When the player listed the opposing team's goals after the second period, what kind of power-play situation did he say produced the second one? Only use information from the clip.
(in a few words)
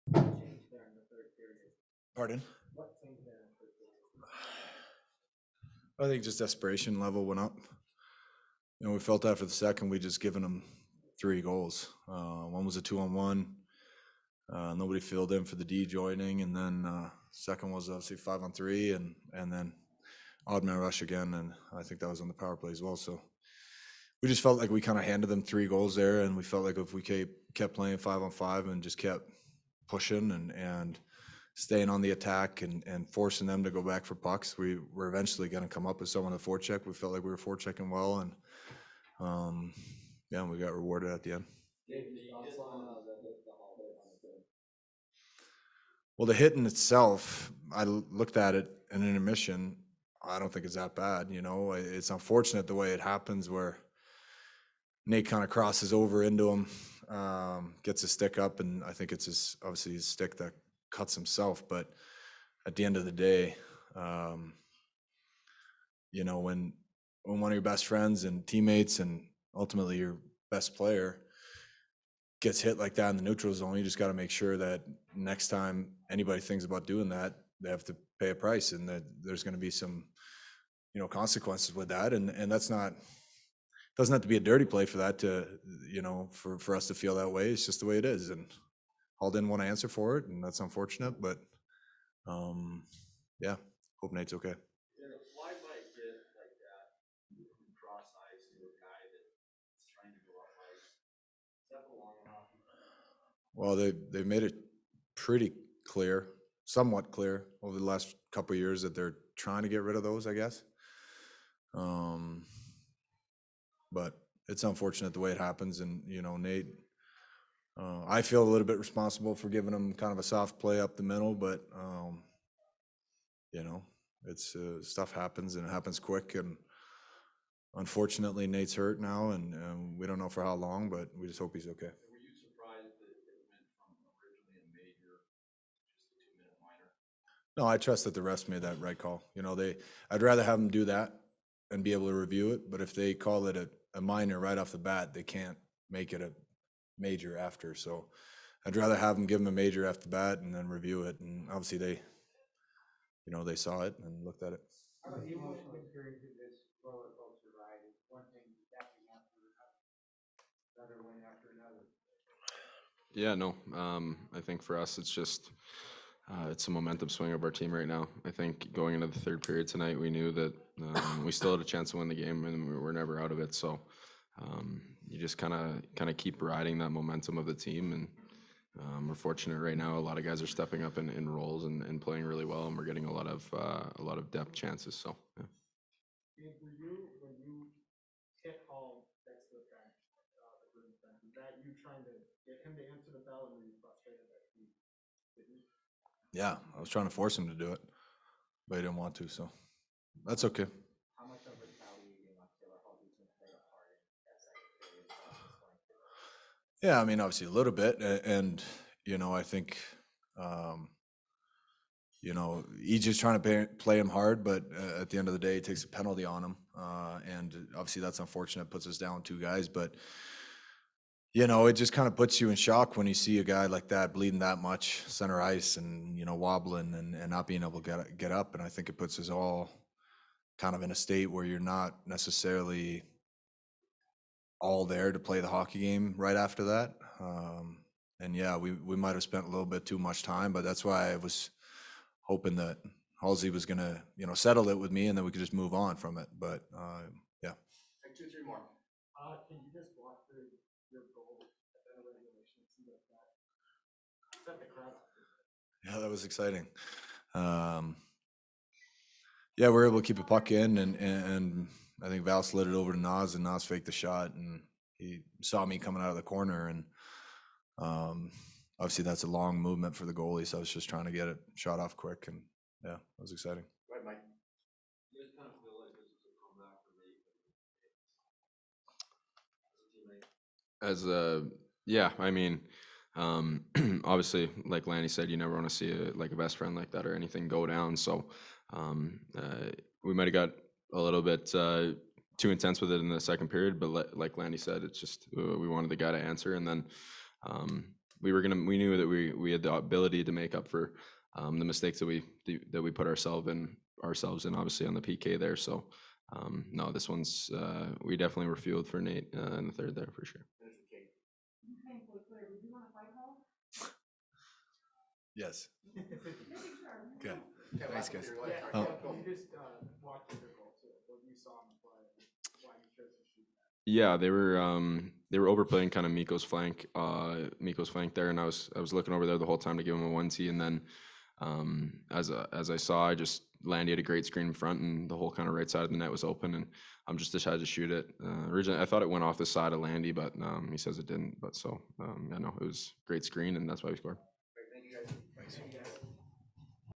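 five on three.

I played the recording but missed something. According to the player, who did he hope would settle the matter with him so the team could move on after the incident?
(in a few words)
Halsey.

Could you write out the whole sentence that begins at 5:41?
But so um, I yeah, know it was great screen, and that's why we scored.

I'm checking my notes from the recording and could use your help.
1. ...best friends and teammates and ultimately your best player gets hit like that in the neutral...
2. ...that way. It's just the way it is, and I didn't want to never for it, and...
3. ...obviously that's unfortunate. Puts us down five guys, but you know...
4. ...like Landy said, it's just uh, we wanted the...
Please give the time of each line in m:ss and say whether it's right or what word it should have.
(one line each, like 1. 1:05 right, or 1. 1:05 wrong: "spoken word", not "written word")
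1. 1:07 right
2. 1:27 wrong: "answer", not "never"
3. 3:37 wrong: "two", not "five"
4. 4:54 right.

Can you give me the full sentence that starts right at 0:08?
You know, we felt after the second, we just given them three goals.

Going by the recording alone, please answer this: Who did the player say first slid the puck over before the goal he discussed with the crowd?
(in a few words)
Val.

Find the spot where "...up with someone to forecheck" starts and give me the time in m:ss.
0:35.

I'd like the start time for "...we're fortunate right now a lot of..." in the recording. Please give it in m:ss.
2:59.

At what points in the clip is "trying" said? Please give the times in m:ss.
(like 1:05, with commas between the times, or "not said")
1:49, 3:16, 3:33, 4:30.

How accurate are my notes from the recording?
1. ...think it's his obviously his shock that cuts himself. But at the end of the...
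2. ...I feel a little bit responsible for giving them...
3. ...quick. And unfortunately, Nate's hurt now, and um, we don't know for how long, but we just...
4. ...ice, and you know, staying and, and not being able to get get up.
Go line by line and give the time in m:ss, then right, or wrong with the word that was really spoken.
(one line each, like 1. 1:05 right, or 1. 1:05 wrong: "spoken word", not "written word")
1. 0:58 wrong: "stick", not "shock"
2. 1:58 right
3. 2:05 right
4. 3:45 wrong: "wobbling", not "staying".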